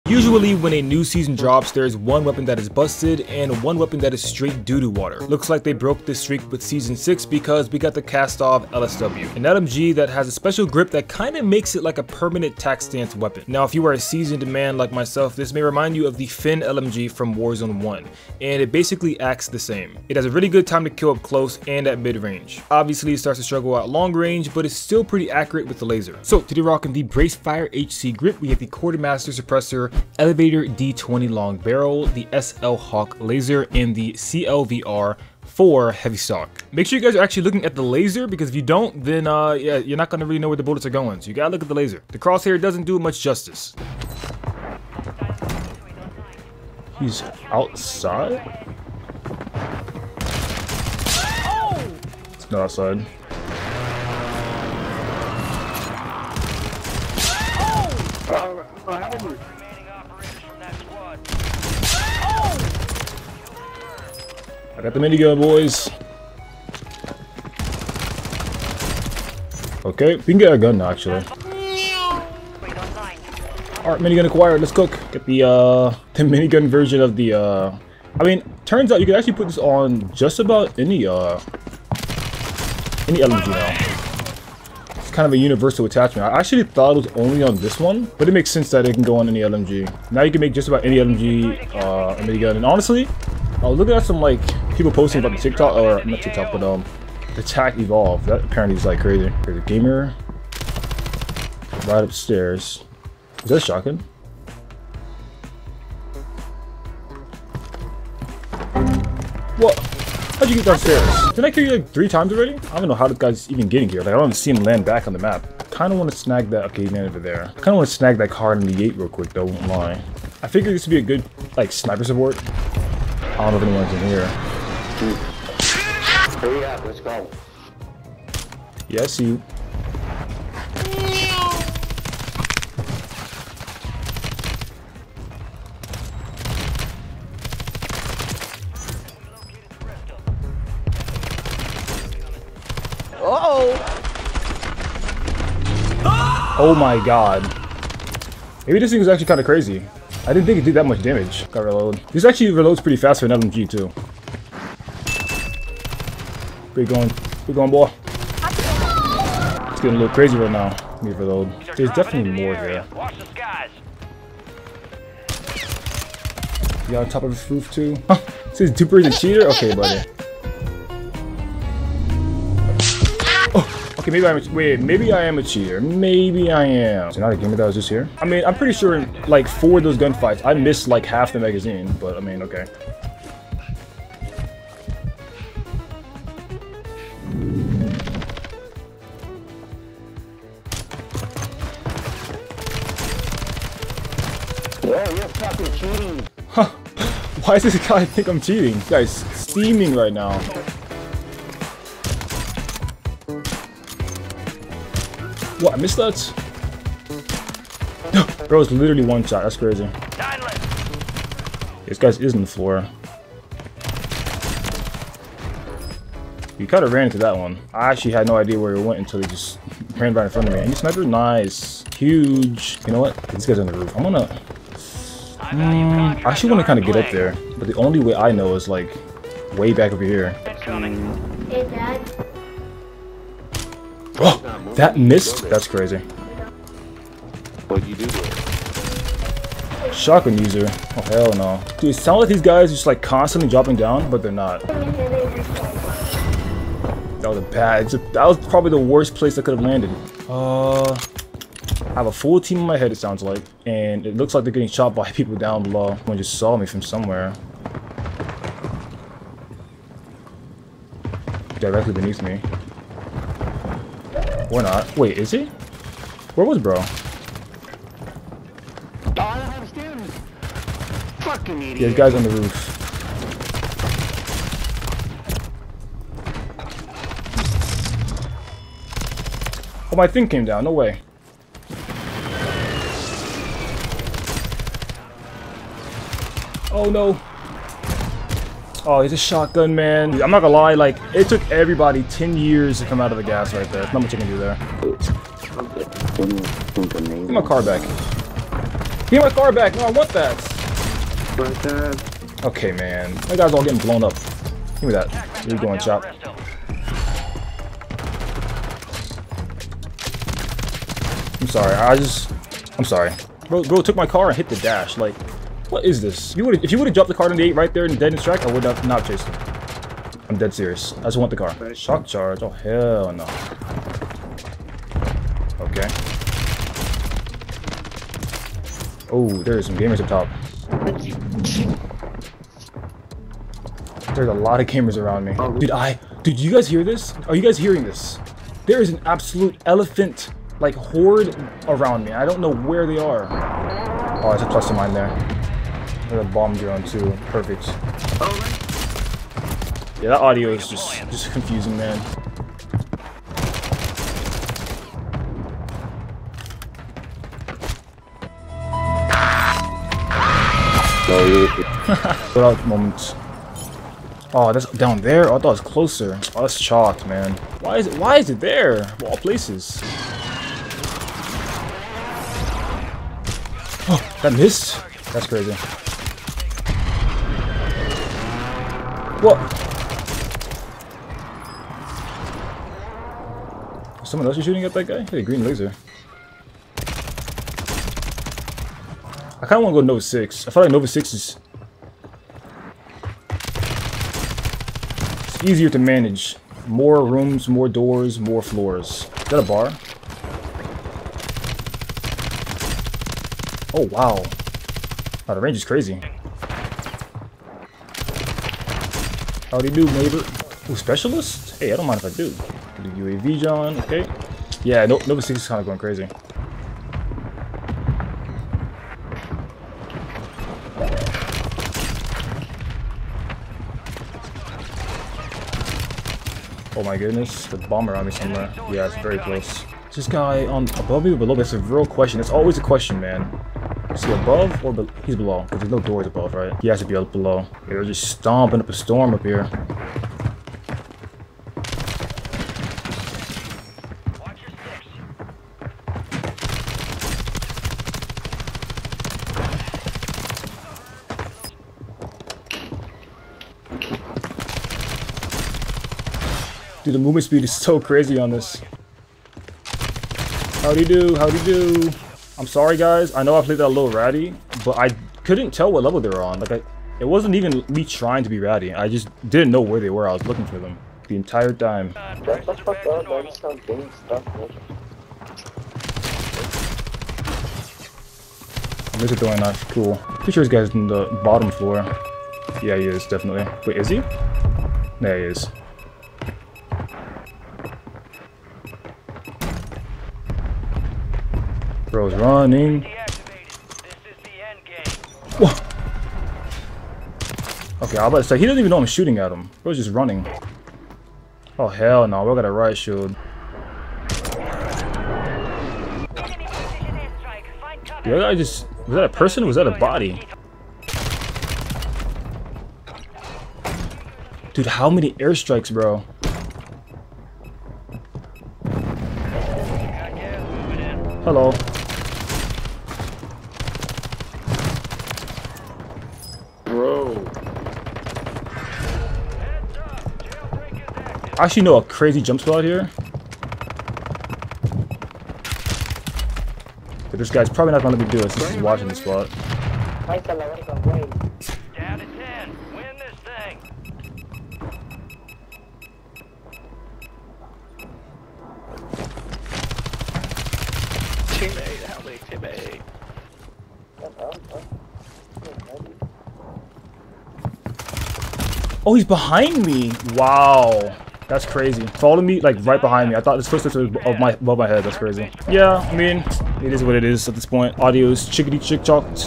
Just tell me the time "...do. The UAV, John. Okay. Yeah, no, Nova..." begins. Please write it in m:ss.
6:52.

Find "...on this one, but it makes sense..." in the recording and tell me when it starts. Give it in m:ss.
1:27.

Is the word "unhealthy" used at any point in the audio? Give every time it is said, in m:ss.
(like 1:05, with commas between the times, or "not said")
not said.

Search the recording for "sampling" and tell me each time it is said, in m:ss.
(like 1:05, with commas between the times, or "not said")
not said.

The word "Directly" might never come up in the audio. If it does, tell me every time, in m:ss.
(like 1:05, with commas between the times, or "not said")
4:21.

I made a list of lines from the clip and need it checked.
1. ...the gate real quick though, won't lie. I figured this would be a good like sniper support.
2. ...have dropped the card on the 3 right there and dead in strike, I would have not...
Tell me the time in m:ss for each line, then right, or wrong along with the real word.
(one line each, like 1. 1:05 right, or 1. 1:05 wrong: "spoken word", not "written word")
1. 1:58 right
2. 5:16 wrong: "8", not "3".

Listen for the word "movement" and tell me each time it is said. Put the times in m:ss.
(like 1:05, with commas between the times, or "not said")
7:36.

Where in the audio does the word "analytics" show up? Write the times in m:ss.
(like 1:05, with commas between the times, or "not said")
not said.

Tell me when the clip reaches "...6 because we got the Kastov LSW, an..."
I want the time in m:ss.
0:06.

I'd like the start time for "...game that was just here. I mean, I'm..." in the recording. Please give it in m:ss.
2:57.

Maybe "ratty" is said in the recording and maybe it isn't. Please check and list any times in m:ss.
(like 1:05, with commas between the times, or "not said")
7:43, 7:48.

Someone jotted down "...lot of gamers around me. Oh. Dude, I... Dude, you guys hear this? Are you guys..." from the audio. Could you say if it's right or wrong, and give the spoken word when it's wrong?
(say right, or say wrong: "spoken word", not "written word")
right.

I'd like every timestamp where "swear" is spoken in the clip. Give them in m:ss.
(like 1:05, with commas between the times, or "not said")
not said.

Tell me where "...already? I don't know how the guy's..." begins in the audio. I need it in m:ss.
1:52.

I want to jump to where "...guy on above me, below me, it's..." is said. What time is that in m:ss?
7:10.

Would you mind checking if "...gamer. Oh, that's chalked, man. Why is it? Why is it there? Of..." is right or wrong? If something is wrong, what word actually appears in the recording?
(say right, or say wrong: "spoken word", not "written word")
wrong: "closer", not "gamer".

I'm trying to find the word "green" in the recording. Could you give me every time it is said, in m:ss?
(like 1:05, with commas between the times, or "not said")
6:25.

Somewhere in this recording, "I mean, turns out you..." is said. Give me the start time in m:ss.
1:18.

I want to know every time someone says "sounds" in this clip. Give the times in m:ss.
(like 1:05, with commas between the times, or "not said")
4:01, 4:12.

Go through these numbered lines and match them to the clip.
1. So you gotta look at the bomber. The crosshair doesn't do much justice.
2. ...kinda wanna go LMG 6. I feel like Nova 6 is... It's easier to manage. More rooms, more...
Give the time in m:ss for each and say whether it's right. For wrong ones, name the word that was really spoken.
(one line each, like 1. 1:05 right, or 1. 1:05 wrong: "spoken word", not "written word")
1. 0:41 wrong: "laser", not "bomber"
2. 6:29 wrong: "Nova", not "LMG".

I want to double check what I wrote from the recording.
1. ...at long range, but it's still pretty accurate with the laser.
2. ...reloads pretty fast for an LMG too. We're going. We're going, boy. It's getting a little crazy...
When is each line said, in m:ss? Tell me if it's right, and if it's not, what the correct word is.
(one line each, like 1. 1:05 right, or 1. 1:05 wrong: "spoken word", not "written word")
1. 0:23 right
2. 2:32 right.